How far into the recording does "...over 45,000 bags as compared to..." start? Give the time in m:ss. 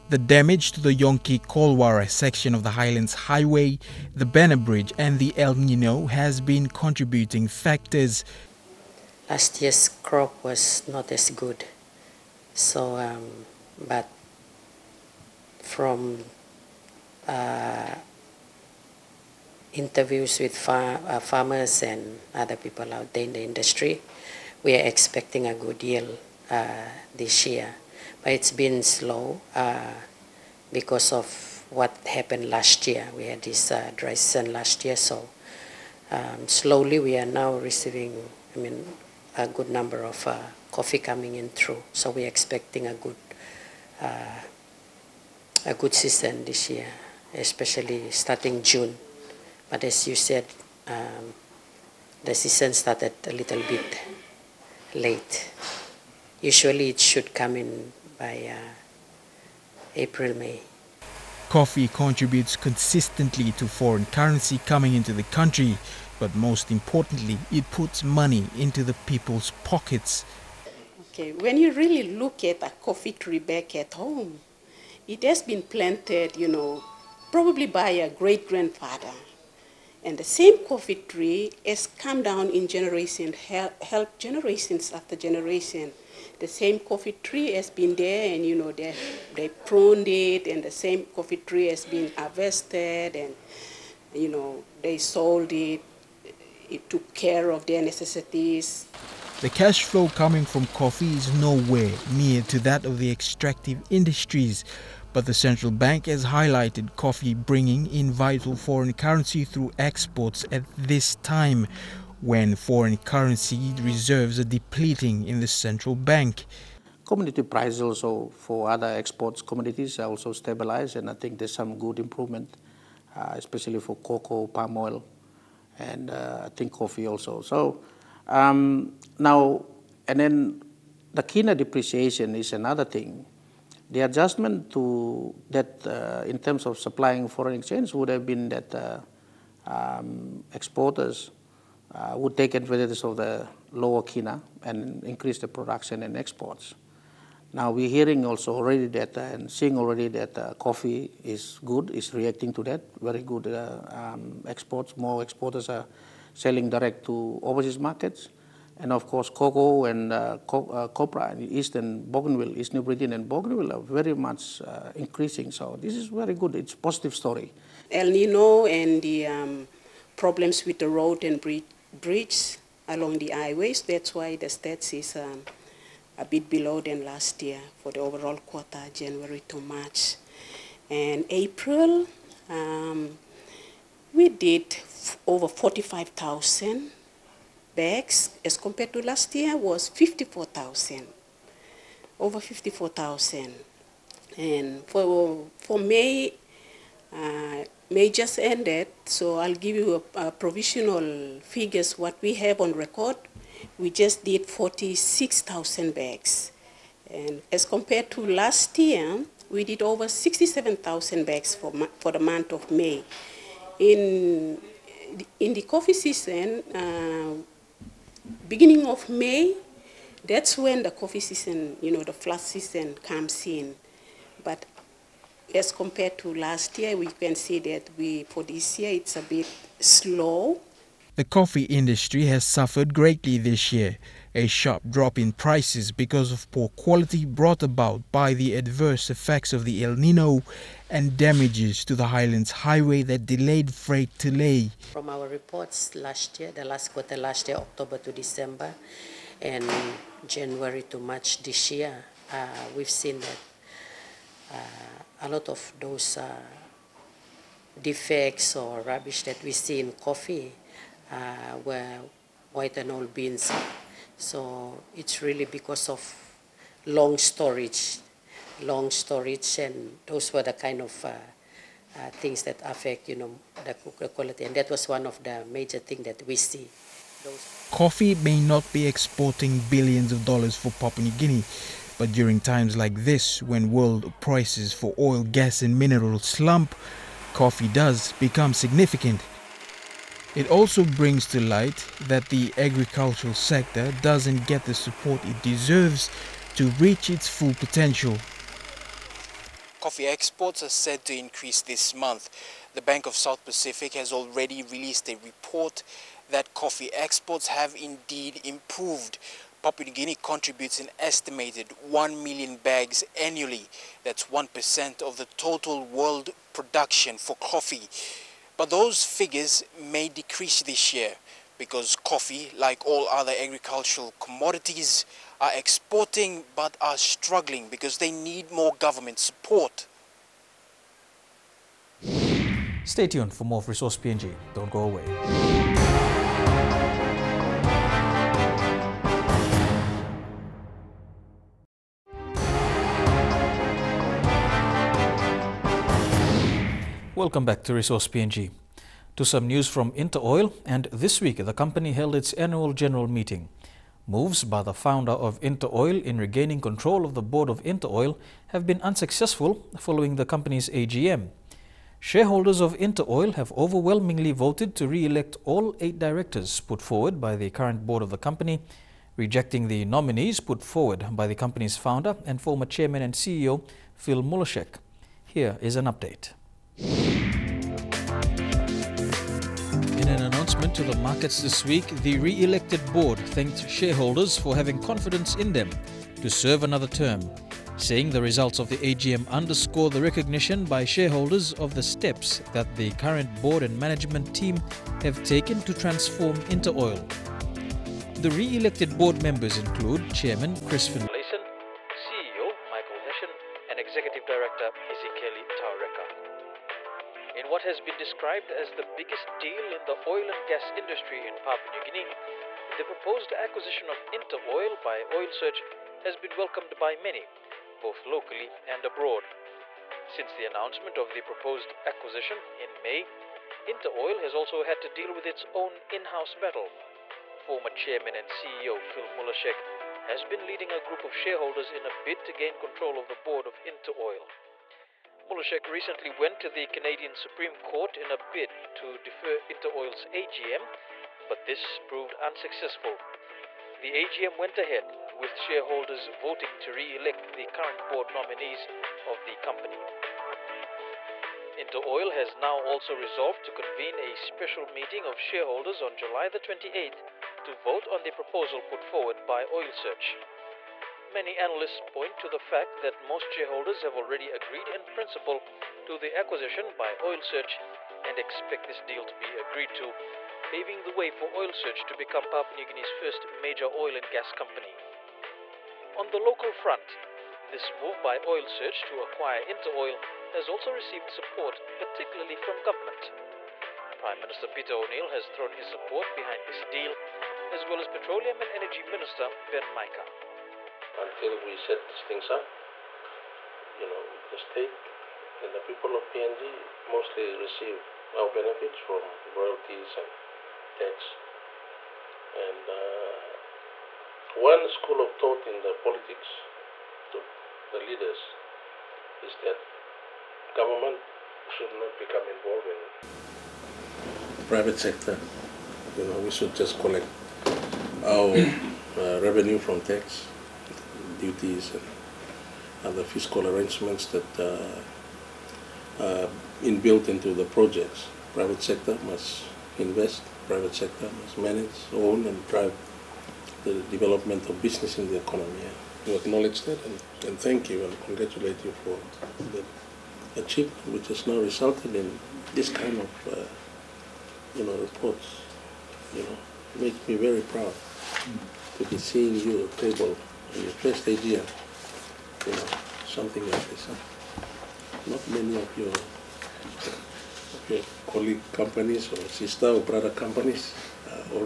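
3:05.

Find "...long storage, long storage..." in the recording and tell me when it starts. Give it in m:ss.
4:26.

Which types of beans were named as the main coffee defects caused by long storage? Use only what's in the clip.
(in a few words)
white and old beans.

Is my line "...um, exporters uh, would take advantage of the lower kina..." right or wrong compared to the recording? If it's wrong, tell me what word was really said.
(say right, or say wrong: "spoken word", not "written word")
right.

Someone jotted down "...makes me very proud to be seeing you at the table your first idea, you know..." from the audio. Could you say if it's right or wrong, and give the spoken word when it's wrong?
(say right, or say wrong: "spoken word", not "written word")
right.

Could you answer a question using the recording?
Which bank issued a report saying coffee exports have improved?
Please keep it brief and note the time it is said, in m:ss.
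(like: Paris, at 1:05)
Bank of South Pacific, at 5:02.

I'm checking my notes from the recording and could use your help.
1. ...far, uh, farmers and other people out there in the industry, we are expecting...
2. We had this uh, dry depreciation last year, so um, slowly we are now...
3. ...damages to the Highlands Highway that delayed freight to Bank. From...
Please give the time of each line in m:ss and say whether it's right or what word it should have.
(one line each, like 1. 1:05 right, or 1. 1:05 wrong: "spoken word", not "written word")
1. 0:20 right
2. 0:33 wrong: "season", not "depreciation"
3. 4:01 wrong: "Lae", not "Bank".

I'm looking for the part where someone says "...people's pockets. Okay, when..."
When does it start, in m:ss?
1:09.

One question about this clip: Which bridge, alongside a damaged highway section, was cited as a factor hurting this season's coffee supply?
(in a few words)
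Banner Bridge.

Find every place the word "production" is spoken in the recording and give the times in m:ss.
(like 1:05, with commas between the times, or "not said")
2:25, 5:16.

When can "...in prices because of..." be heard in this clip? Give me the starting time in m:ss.
3:55.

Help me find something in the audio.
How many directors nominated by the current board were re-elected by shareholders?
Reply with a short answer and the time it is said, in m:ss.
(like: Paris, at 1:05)
8, at 6:05.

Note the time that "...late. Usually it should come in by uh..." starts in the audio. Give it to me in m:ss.
0:54.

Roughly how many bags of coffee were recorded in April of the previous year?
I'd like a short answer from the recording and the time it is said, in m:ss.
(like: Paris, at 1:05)
54,000, at 3:12.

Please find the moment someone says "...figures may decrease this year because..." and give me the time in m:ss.
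5:19.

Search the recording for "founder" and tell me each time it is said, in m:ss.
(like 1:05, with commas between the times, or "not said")
5:54, 6:11.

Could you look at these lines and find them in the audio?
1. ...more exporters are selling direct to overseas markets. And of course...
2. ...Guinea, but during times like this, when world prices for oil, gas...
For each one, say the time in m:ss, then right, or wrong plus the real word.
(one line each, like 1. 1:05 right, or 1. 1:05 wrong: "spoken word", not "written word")
1. 2:34 right
2. 4:41 right.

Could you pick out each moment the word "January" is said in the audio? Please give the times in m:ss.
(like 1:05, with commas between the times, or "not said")
2:58, 4:10.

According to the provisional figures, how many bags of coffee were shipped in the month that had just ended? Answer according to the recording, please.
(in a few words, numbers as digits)
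46,000.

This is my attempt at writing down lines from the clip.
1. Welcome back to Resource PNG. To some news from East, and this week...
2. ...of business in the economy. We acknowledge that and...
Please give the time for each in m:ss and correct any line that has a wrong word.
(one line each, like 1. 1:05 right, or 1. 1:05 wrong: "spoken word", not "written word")
1. 5:47 wrong: "InterOil", not "East"
2. 8:54 right.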